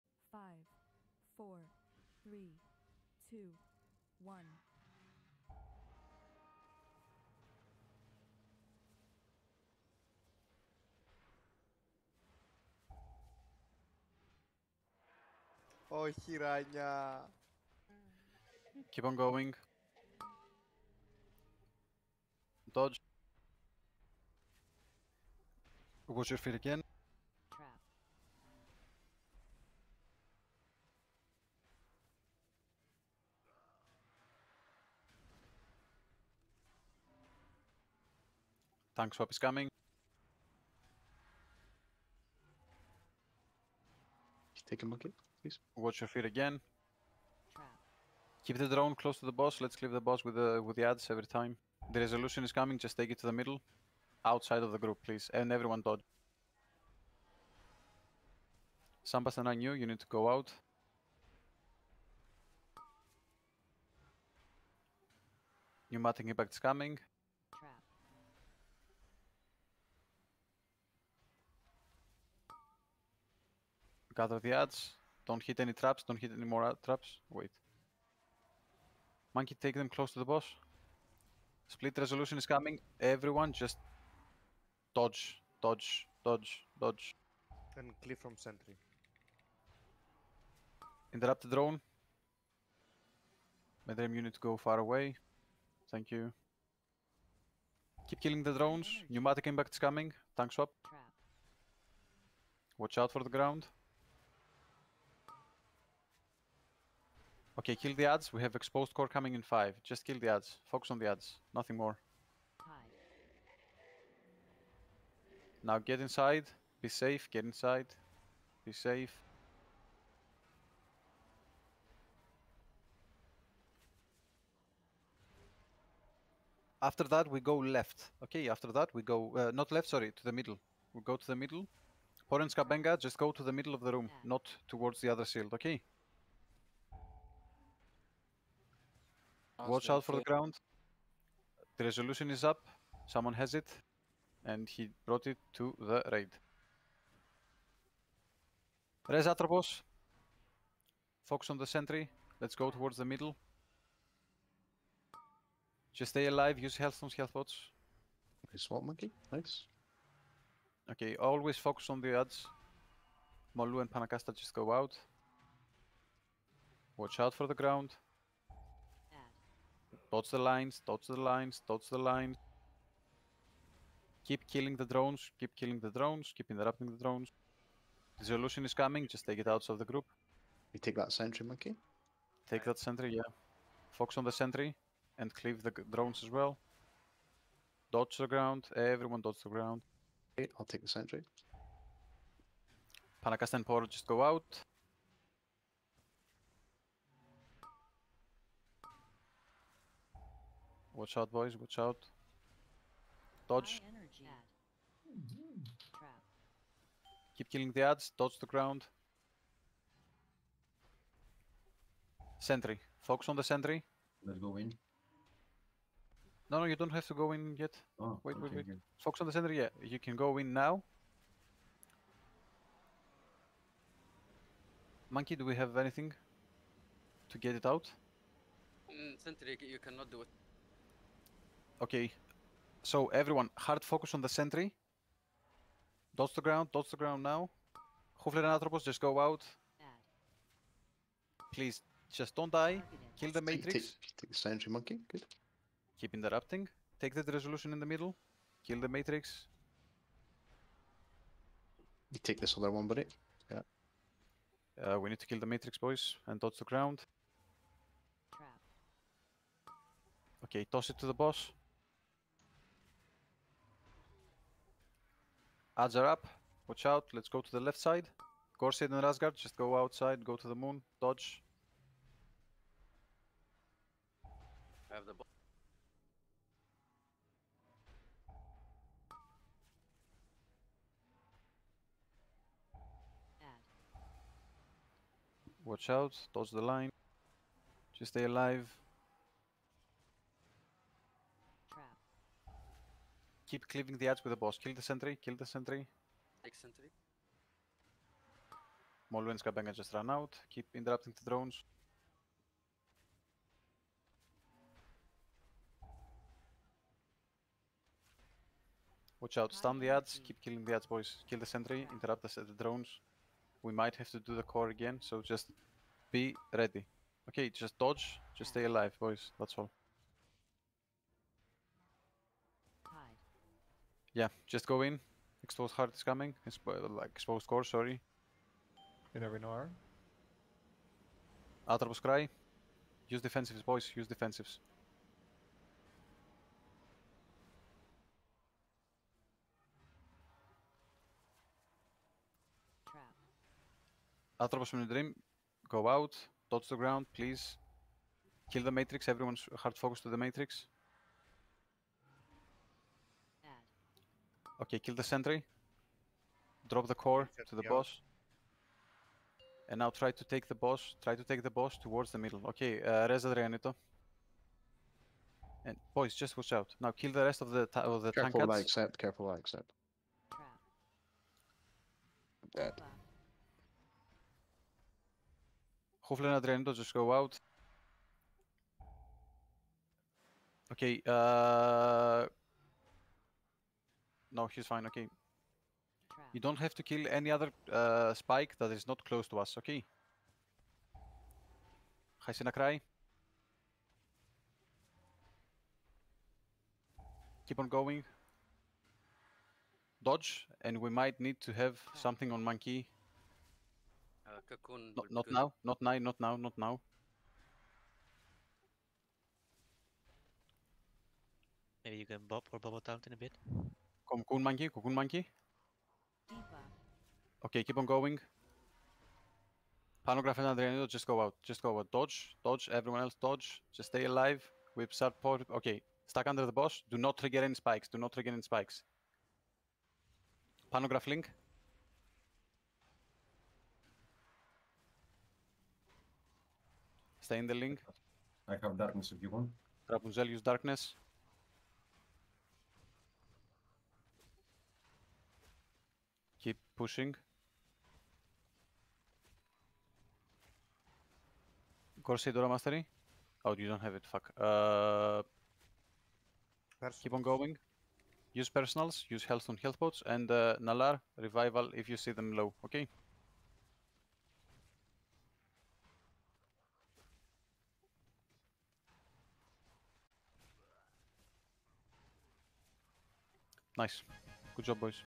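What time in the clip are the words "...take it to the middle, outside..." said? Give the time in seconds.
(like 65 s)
52 s.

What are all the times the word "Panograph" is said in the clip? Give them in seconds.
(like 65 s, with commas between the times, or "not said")
420 s, 430 s.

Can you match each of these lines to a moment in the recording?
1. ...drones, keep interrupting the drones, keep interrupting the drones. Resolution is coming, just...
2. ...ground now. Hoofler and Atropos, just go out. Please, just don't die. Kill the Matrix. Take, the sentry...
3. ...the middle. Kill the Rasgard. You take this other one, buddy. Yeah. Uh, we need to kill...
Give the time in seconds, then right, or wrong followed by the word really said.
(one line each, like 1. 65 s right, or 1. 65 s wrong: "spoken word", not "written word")
1. 174 s wrong: "killing", not "interrupting"
2. 236 s right
3. 247 s wrong: "Matrix", not "Rasgard".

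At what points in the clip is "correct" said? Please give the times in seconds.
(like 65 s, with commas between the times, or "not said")
not said.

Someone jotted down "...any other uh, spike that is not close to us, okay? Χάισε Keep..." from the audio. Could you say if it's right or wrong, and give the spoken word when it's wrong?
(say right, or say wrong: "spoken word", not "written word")
right.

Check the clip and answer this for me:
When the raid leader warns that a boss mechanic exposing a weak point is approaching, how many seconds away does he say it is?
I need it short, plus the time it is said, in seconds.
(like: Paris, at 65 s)
5, at 108 s.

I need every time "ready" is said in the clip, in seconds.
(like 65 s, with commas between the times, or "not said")
316 s.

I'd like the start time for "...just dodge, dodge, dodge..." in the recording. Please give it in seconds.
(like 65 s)
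83 s.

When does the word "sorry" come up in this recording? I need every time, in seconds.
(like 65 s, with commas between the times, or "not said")
129 s, 327 s.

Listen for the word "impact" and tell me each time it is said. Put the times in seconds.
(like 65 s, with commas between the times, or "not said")
66 s, 99 s.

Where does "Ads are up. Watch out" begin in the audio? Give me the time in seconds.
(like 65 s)
265 s.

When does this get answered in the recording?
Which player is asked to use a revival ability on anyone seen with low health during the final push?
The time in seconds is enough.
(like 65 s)
460 s.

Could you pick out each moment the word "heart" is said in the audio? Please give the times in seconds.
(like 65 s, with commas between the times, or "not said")
325 s.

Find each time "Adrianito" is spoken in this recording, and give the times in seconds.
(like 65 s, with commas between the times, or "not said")
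363 s, 376 s.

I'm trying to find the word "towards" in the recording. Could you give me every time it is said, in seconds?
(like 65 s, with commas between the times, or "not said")
134 s, 152 s, 361 s.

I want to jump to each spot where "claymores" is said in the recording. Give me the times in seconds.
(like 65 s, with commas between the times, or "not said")
not said.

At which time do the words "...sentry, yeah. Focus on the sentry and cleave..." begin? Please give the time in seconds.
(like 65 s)
182 s.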